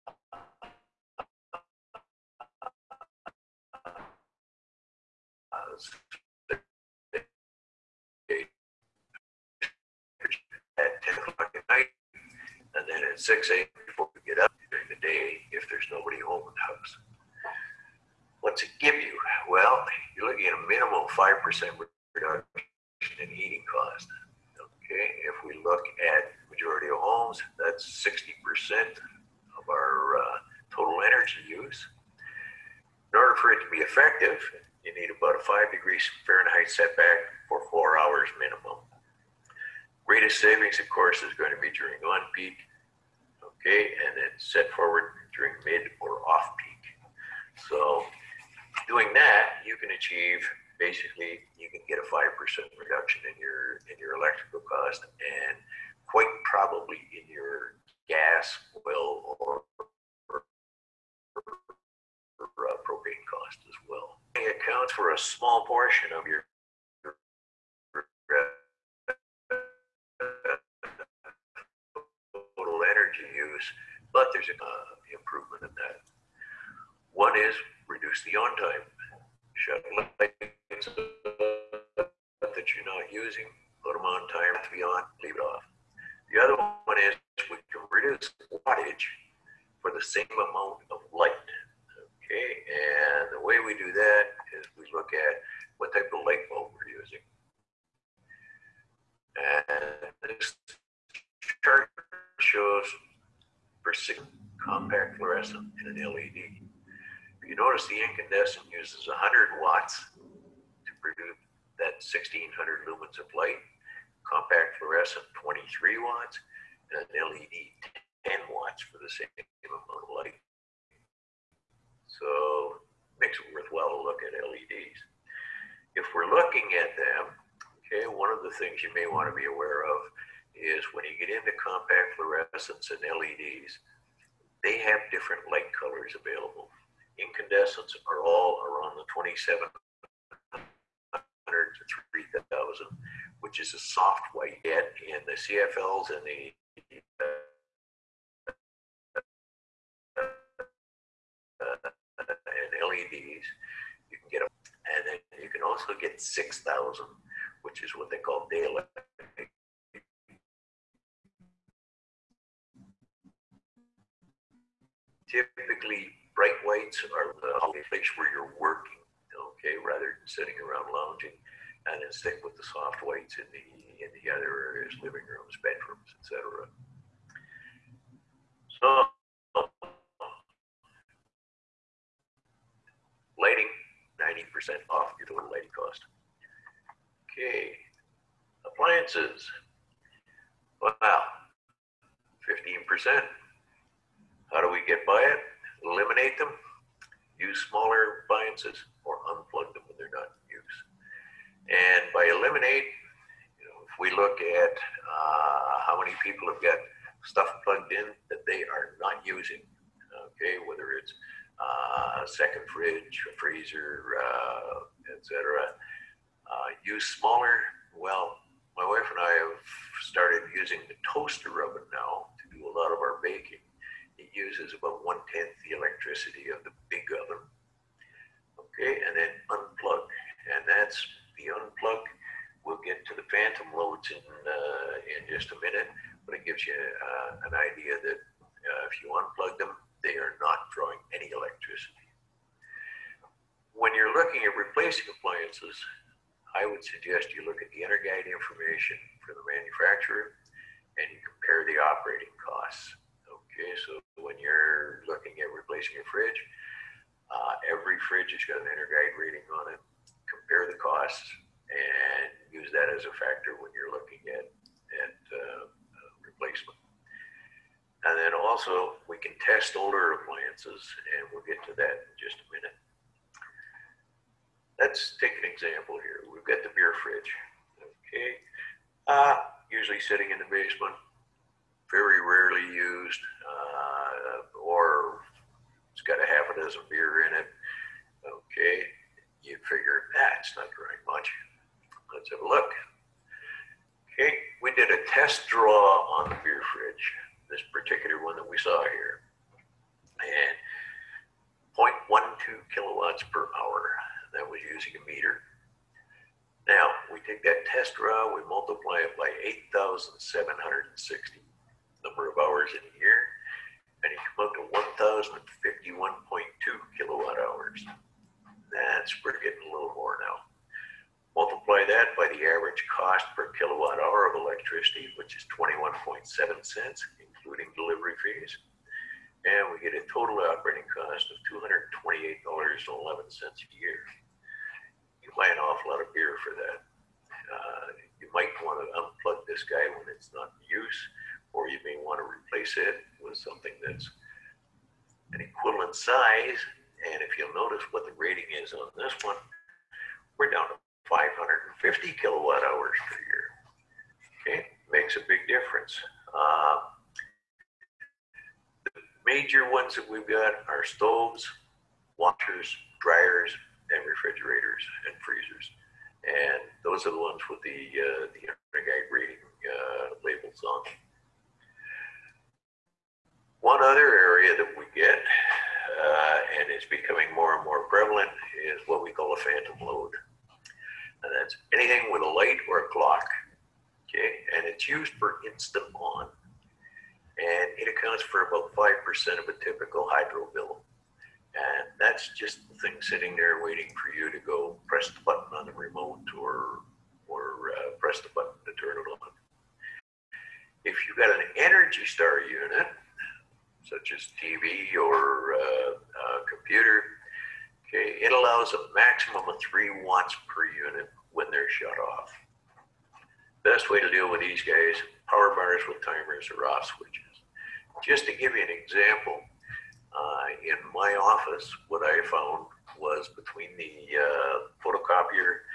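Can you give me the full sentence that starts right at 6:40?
If you've got an Energy Star unit, such as TV or uh, uh, computer.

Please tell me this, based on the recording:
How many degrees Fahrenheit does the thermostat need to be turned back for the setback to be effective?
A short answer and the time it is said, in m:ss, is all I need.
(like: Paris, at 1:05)
5, at 0:35.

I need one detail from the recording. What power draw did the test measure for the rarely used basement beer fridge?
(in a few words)
0.12 kilowatts per hour.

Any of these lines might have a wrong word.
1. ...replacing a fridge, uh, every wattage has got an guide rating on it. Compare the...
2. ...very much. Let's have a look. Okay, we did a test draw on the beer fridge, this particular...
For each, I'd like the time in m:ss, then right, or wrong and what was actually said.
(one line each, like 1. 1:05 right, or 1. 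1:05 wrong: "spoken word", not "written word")
1. 4:15 wrong: "fridge", not "wattage"
2. 4:50 right.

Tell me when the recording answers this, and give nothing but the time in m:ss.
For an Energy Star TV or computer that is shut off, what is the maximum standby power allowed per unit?
6:49.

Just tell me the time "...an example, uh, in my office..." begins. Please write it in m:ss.
6:58.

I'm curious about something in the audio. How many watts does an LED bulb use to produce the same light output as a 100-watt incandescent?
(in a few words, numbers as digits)
10 watts.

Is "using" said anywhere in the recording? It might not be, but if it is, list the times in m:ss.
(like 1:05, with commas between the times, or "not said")
1:23, 1:36, 3:29, 3:40, 5:04.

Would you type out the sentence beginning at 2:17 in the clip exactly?
Incandescents are all around the 2700 to 3000, which is a soft white.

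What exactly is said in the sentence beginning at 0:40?
Greatest savings, of course, is going to be during on peak okay, and it's set forward during mid or off peak.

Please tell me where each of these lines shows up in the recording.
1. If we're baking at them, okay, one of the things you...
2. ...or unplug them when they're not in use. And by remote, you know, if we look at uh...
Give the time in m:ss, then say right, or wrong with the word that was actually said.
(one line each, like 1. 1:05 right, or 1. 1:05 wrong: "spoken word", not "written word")
1. 2:05 wrong: "looking", not "baking"
2. 3:19 wrong: "eliminate", not "remote".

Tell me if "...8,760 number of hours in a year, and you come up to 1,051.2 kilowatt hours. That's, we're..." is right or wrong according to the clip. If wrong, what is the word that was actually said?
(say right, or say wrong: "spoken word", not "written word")
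right.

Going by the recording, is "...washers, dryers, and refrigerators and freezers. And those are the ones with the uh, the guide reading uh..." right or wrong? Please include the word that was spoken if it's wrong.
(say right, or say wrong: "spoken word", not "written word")
right.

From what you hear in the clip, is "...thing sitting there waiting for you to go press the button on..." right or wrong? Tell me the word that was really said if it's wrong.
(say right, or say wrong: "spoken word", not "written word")
right.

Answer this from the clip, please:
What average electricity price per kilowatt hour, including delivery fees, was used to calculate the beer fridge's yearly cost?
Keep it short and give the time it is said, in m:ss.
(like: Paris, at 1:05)
21.7 cents, at 5:25.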